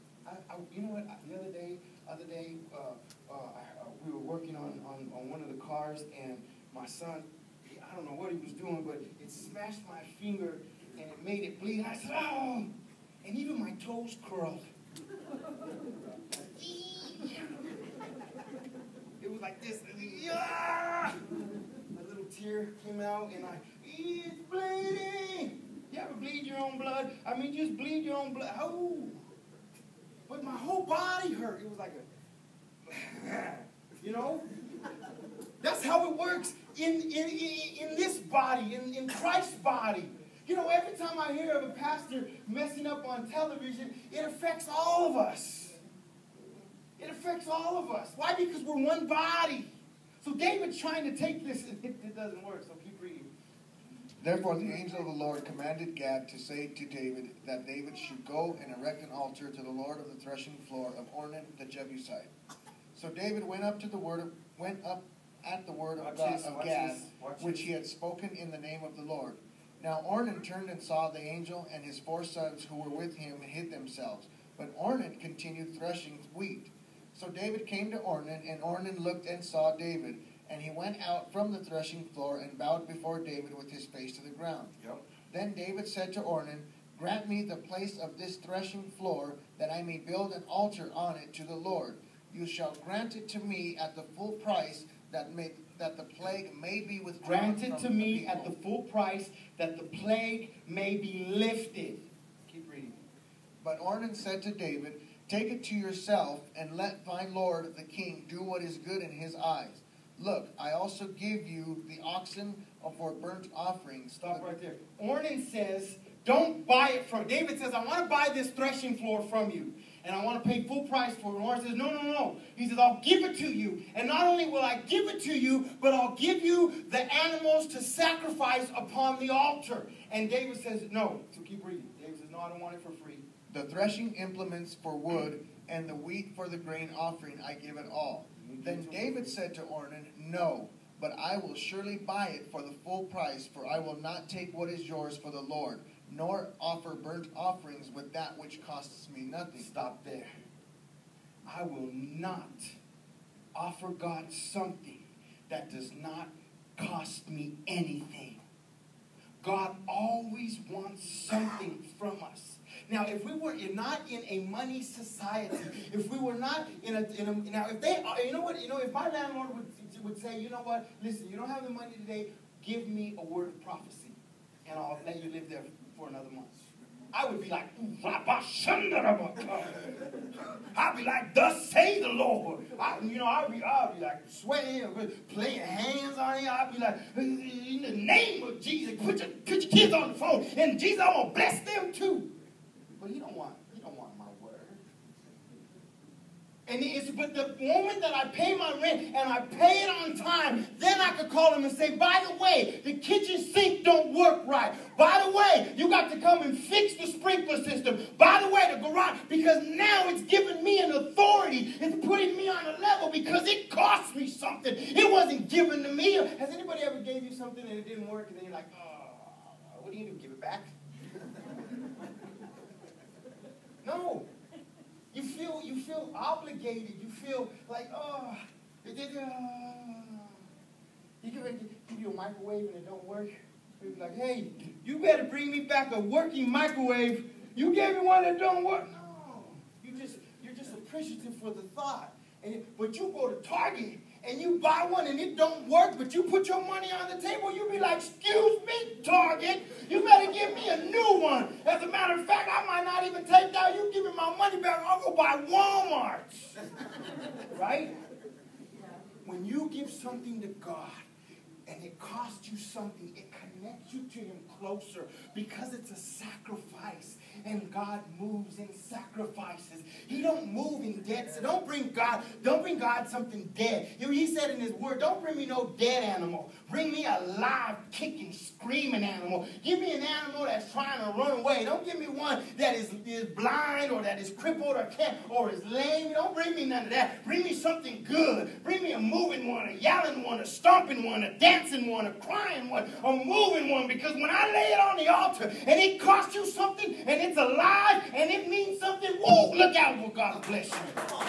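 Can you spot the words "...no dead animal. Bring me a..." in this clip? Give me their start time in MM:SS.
04:35.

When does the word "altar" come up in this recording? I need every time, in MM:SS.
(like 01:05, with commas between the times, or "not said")
00:59, 01:30, 02:09, 04:55.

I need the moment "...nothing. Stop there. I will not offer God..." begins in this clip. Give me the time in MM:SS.
02:29.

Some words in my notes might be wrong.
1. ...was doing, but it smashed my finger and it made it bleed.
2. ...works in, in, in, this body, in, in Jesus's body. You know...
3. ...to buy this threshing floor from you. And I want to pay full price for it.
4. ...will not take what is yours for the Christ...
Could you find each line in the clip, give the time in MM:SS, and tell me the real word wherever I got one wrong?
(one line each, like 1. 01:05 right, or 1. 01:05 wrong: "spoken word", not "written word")
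1. 00:08 right
2. 00:36 wrong: "Christ", not "Jesus"
3. 01:58 right
4. 02:23 wrong: "Lord", not "Christ".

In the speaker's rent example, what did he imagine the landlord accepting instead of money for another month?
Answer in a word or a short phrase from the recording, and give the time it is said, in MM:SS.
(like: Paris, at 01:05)
A word of prophecy, at 02:53.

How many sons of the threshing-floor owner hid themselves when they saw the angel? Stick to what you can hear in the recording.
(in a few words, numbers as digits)
4.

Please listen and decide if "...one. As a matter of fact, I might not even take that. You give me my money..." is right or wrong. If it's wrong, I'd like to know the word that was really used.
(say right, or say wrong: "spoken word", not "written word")
right.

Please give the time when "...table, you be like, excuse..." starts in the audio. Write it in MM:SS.
04:07.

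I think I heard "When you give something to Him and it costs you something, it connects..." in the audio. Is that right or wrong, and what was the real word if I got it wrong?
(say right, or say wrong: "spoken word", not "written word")
wrong: "God", not "Him".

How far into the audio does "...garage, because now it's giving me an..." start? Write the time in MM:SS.
03:28.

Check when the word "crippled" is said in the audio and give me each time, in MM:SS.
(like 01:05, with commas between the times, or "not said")
04:44.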